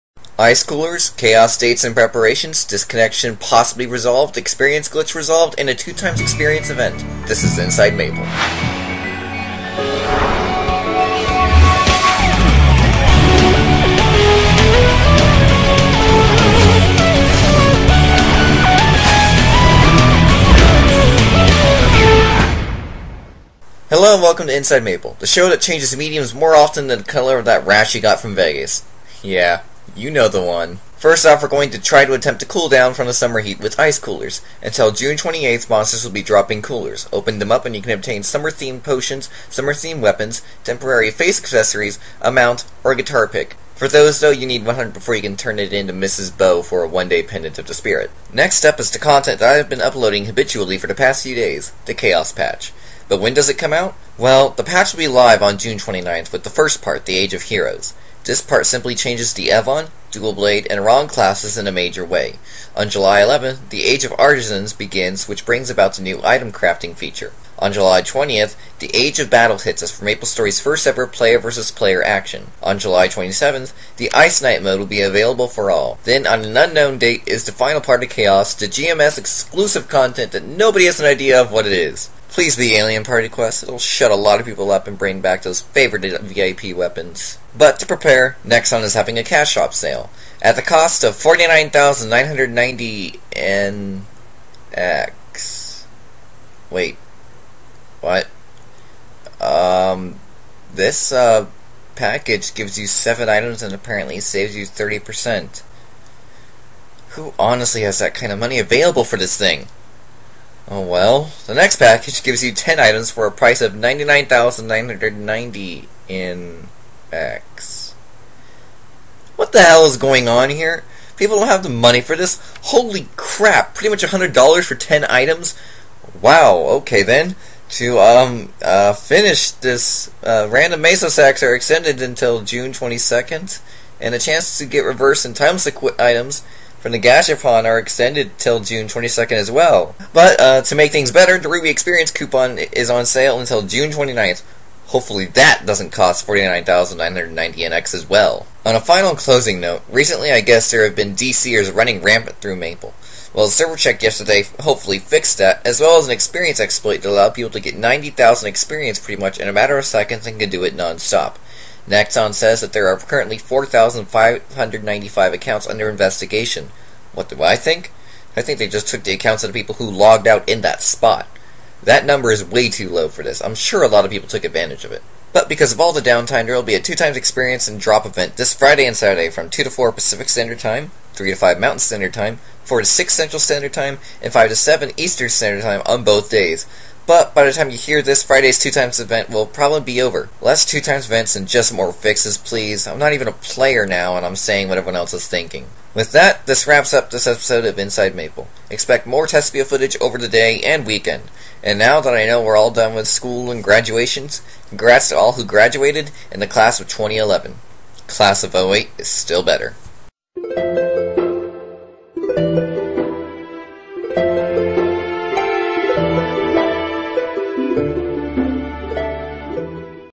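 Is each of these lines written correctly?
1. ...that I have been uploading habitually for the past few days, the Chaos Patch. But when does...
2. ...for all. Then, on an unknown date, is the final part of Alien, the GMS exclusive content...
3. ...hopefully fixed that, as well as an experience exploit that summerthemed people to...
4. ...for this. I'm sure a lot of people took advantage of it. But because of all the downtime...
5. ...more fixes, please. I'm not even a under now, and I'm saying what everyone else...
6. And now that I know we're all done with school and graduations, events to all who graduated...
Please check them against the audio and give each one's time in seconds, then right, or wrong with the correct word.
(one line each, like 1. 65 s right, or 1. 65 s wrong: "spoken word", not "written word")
1. 49 s right
2. 75 s wrong: "Chaos", not "Alien"
3. 154 s wrong: "allowed", not "summerthemed"
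4. 173 s right
5. 191 s wrong: "player", not "under"
6. 201 s wrong: "congrats", not "events".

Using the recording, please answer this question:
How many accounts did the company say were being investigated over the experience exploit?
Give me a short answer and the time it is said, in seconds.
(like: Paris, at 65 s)
4,595, at 163 s.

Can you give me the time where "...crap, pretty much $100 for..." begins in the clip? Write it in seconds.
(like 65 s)
123 s.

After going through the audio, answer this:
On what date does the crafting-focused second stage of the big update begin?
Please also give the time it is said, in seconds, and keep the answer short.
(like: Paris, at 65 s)
July 11th, at 62 s.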